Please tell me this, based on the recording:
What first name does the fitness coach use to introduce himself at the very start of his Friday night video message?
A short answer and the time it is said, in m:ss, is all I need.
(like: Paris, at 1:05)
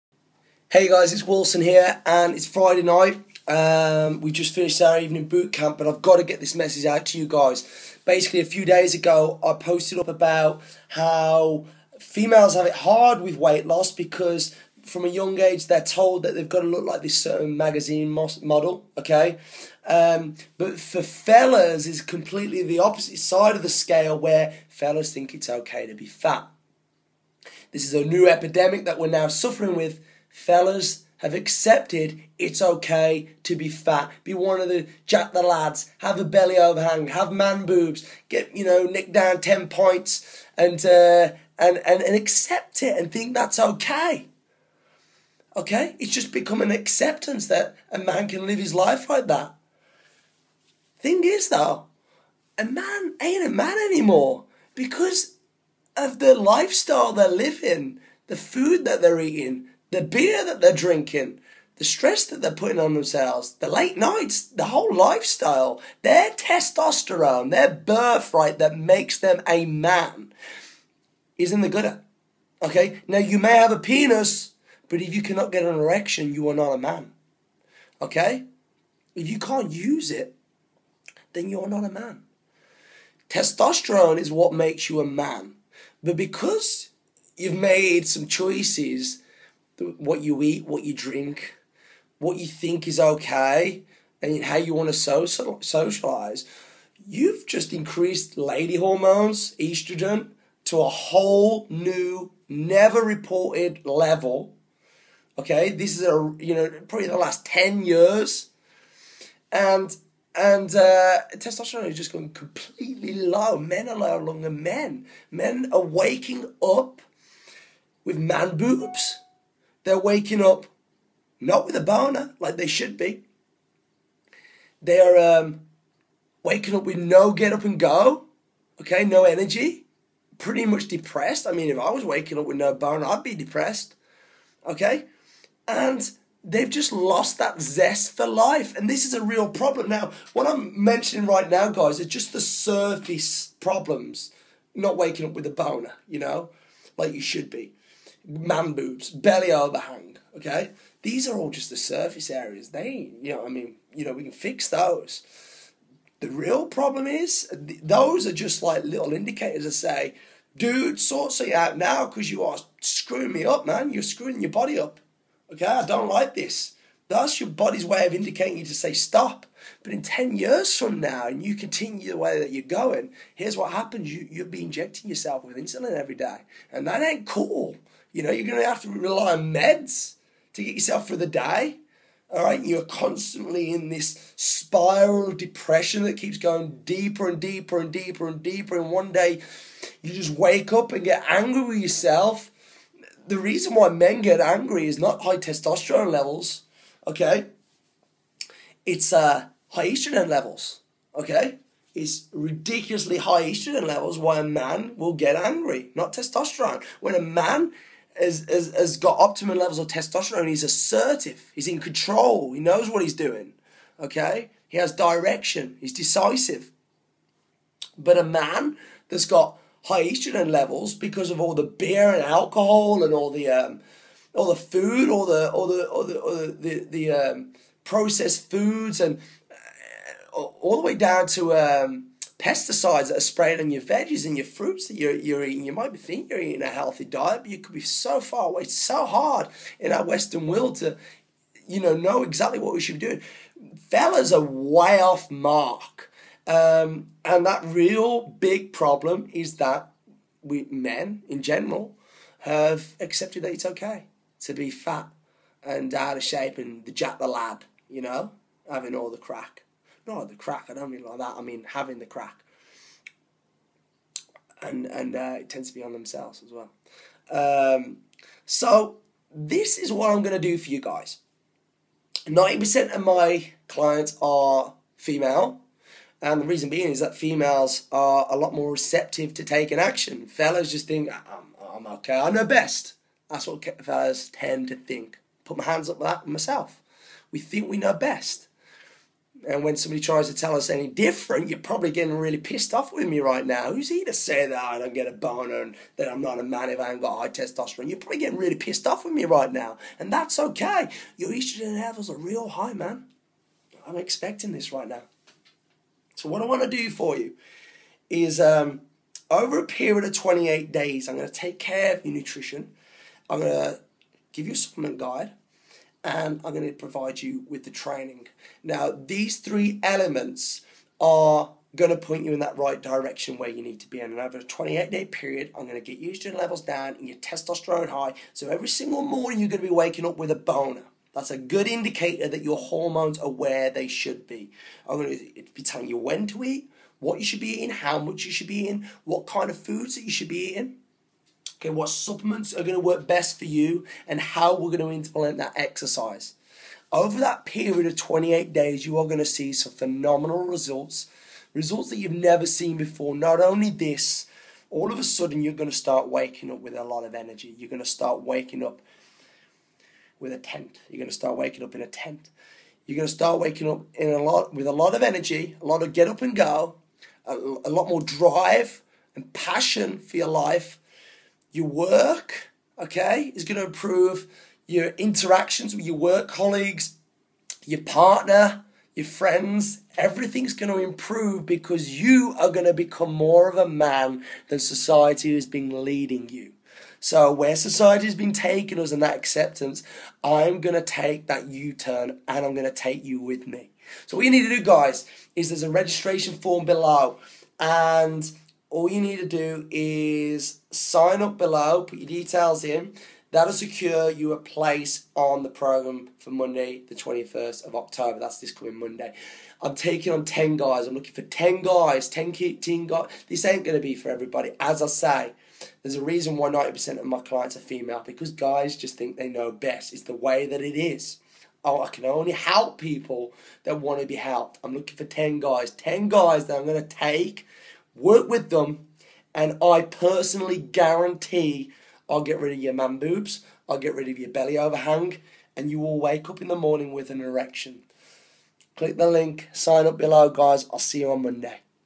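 Wilson, at 0:01.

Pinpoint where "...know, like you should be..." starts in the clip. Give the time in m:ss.
2:26.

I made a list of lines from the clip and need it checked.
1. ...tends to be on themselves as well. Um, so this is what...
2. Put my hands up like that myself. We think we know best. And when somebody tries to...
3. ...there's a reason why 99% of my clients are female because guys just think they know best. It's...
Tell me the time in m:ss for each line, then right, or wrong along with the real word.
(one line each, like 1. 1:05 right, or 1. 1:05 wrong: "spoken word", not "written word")
1. 4:25 right
2. 4:45 right
3. 6:55 wrong: "90", not "99".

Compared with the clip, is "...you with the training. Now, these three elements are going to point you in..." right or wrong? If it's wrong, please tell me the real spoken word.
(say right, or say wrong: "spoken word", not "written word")
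right.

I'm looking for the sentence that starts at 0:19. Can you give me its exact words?
Um, but for fellas, it's completely the opposite side of the scale where fellas think it's okay to be fat.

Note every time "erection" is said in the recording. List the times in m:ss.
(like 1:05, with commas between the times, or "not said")
1:15, 7:17.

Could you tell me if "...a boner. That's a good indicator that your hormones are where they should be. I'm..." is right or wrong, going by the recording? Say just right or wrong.
right.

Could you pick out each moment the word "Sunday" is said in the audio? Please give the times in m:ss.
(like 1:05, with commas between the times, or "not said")
not said.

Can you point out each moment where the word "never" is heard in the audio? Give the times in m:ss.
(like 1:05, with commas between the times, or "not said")
1:42, 5:52.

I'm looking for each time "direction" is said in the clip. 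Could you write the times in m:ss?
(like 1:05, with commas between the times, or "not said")
3:34, 5:22.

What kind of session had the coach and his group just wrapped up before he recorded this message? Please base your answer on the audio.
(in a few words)
Evening boot camp.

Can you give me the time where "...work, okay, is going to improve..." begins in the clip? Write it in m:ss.
6:11.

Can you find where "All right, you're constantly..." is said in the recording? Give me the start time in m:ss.
3:02.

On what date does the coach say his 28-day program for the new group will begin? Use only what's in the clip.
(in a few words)
Monday, 21st of October.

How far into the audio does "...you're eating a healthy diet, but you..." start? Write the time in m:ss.
3:56.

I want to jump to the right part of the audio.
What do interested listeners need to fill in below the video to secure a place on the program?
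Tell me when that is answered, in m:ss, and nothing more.
6:35.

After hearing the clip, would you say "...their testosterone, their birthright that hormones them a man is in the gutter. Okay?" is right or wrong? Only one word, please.
wrong.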